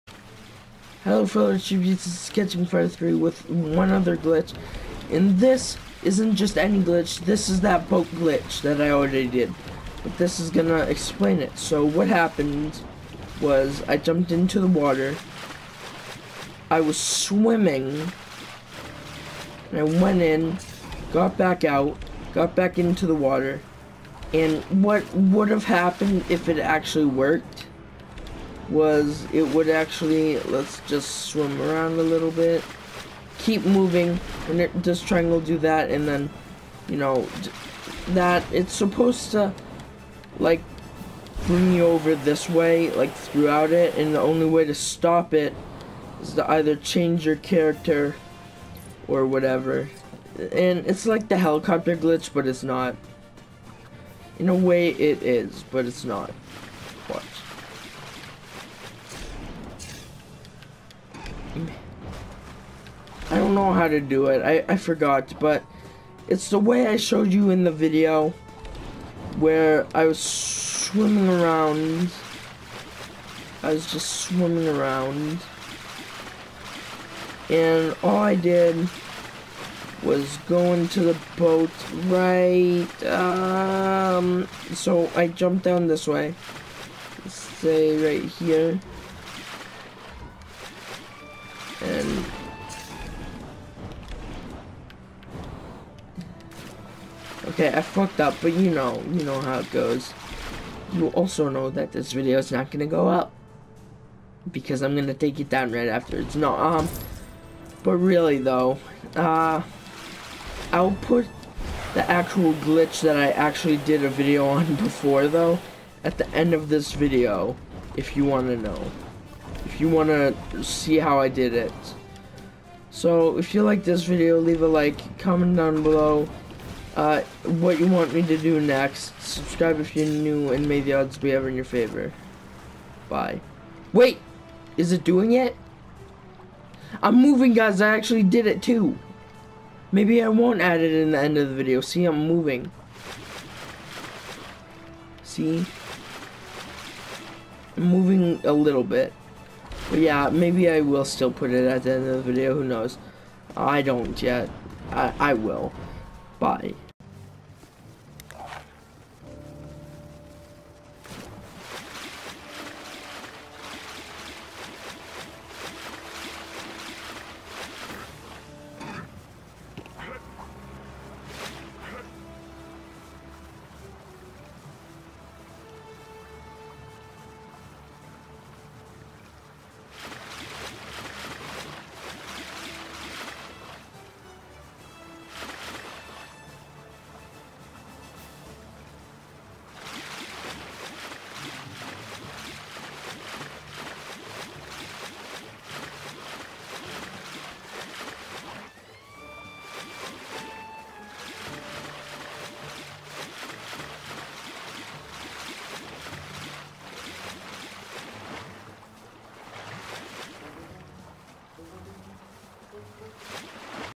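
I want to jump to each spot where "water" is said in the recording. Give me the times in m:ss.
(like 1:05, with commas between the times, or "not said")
0:14, 0:23.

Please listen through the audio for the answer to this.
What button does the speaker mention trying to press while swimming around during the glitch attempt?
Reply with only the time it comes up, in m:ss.
0:35.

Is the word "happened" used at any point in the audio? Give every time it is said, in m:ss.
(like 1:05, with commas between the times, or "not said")
0:12, 0:25.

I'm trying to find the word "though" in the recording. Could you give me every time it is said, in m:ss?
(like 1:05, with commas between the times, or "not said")
1:48, 1:55.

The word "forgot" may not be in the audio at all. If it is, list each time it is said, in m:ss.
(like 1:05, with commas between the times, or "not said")
1:04.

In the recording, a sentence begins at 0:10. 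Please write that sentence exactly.
But this is gonna explain it.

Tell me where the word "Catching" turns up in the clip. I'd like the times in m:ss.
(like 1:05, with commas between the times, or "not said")
0:02.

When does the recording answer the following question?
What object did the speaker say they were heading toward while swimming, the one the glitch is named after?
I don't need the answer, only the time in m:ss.
1:21.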